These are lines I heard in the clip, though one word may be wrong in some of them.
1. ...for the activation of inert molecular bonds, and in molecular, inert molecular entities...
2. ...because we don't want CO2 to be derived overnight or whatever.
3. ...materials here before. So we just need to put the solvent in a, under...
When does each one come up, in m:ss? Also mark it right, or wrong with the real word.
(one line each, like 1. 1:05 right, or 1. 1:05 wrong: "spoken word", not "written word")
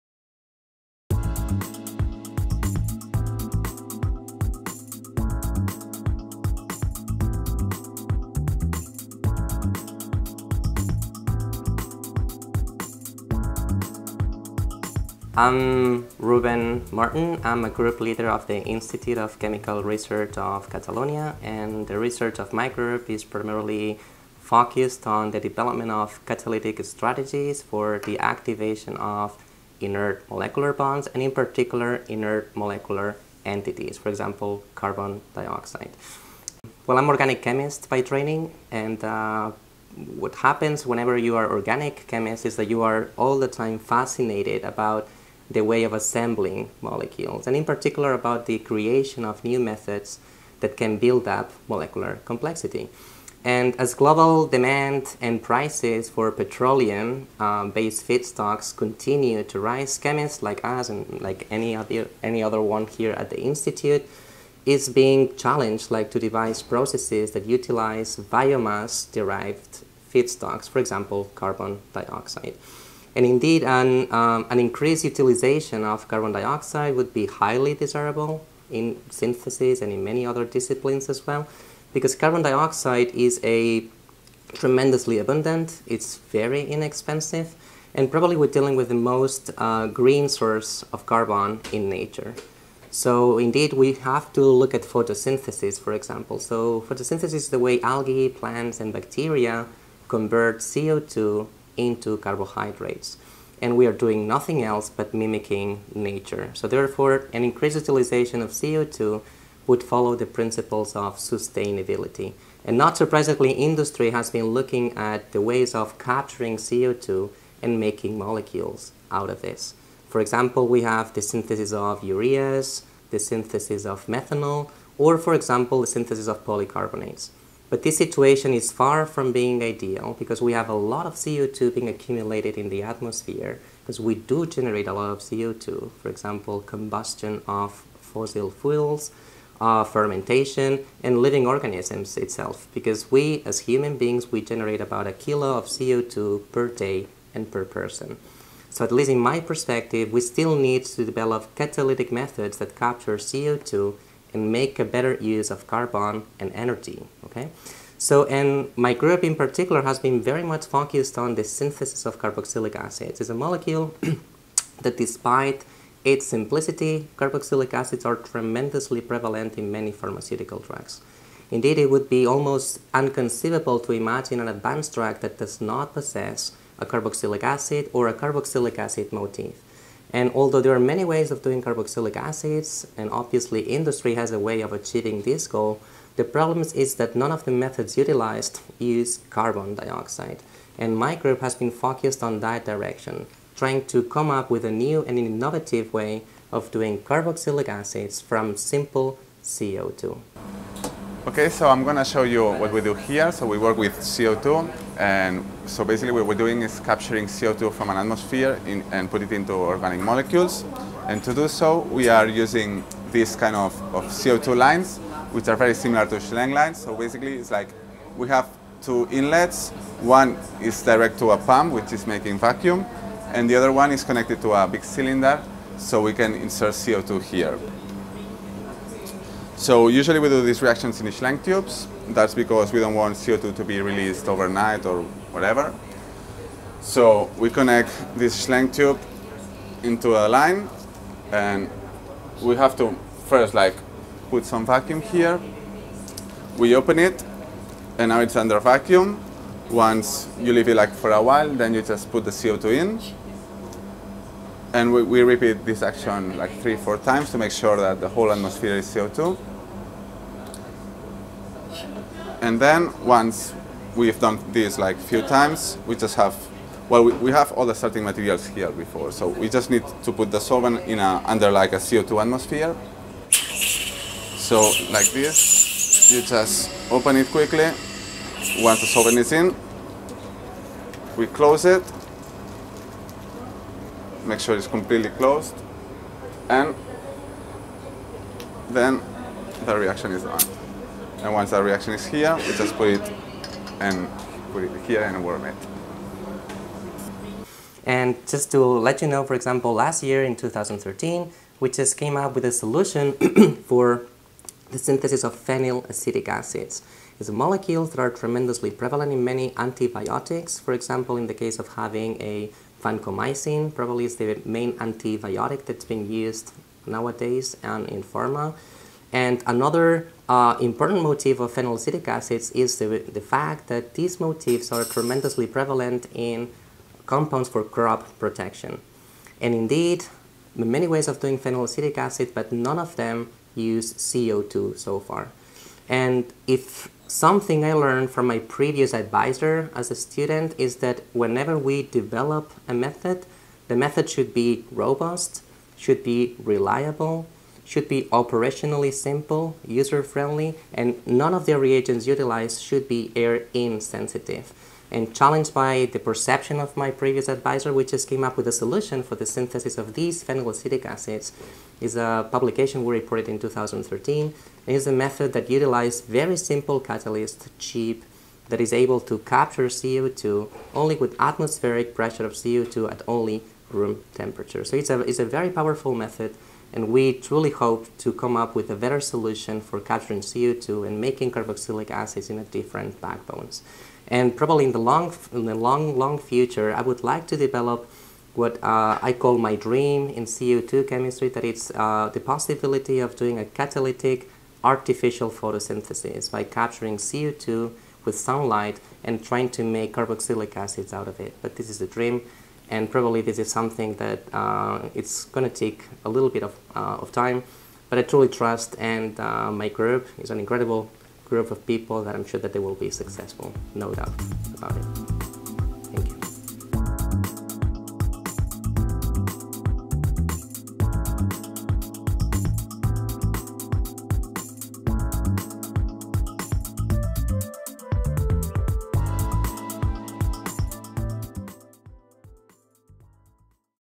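1. 0:27 wrong: "particular", not "molecular"
2. 3:52 wrong: "released", not "derived"
3. 4:28 right.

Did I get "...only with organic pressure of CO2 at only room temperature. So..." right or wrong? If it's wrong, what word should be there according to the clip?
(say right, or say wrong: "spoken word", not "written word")
wrong: "atmospheric", not "organic".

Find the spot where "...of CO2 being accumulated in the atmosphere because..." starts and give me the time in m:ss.
2:11.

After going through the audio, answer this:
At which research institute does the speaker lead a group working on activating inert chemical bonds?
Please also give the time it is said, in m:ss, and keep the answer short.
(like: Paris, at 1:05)
Institute of Chemical Research of Catalonia, at 0:18.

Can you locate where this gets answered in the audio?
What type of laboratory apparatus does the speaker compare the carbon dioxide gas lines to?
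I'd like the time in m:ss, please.
3:36.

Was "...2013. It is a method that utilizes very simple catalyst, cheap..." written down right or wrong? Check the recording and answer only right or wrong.
right.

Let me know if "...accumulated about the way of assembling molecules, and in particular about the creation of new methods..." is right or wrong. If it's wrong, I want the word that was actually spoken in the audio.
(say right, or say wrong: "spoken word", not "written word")
wrong: "fascinated", not "accumulated".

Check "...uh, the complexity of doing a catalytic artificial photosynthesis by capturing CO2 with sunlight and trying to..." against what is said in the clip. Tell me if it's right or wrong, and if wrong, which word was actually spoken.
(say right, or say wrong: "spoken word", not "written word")
wrong: "possibility", not "complexity".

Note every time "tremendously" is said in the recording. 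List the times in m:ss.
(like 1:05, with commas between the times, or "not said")
1:24, 2:48, 5:08, 5:24.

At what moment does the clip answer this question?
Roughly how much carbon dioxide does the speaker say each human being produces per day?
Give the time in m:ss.
2:24.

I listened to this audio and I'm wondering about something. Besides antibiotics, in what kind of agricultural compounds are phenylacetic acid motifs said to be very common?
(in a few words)
crop protection.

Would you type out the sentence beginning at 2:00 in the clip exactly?
For example, we have the synthesis of ureas, the synthesis of methanol, or for example, the synthesis of polycarbonates.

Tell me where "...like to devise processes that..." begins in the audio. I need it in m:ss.
1:05.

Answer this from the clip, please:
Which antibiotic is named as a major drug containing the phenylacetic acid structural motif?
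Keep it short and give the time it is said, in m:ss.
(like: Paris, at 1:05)
vancomycin, at 5:12.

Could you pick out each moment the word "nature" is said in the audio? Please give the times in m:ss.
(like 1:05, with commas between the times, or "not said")
1:31, 1:45.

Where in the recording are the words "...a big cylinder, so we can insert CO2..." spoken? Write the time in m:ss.
3:44.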